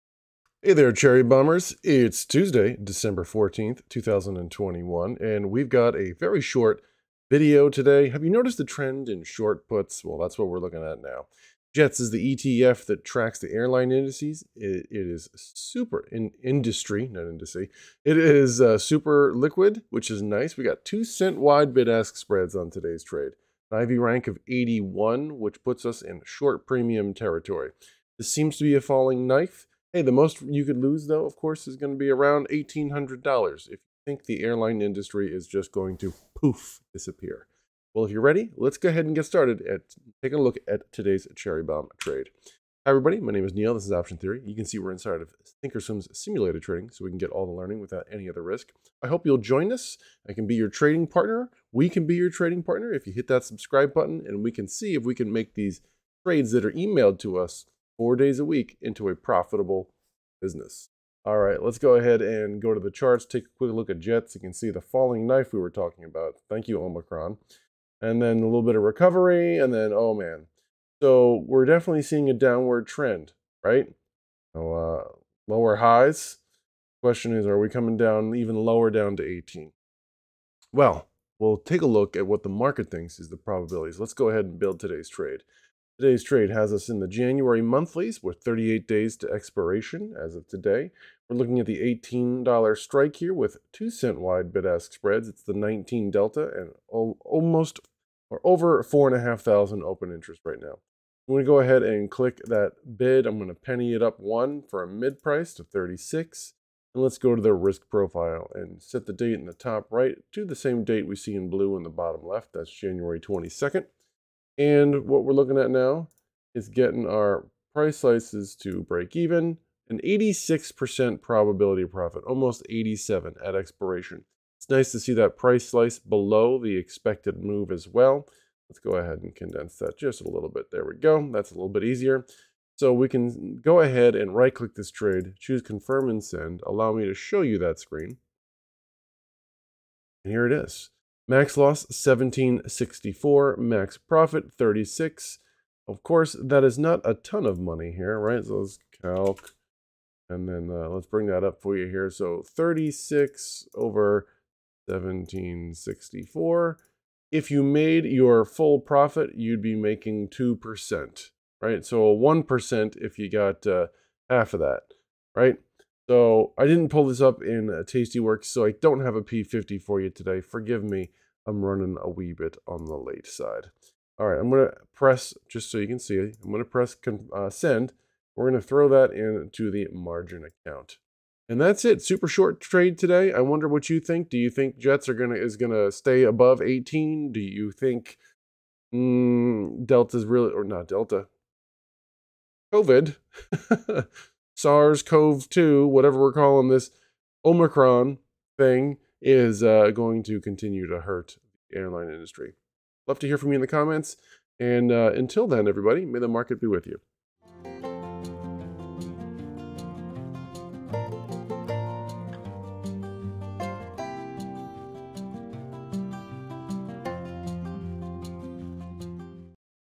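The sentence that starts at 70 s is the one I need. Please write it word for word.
So we're definitely seeing a downward trend, right?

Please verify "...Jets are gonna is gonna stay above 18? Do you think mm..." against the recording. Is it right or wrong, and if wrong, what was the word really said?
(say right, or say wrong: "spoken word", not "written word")
right.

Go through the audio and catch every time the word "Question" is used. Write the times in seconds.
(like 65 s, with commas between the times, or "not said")
77 s.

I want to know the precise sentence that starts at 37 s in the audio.
Well, if you're ready, let's go ahead and get started at taking a look at today's cherry bomb trade.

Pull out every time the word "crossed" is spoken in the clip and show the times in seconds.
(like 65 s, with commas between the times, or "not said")
not said.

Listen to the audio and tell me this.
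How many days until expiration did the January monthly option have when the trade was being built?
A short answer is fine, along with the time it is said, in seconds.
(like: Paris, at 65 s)
38, at 88 s.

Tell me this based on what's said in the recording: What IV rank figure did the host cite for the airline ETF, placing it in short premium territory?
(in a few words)
81.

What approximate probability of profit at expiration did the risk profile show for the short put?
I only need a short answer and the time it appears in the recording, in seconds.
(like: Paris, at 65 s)
86%, at 120 s.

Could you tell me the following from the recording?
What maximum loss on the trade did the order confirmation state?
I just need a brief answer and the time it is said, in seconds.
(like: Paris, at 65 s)
1764, at 141 s.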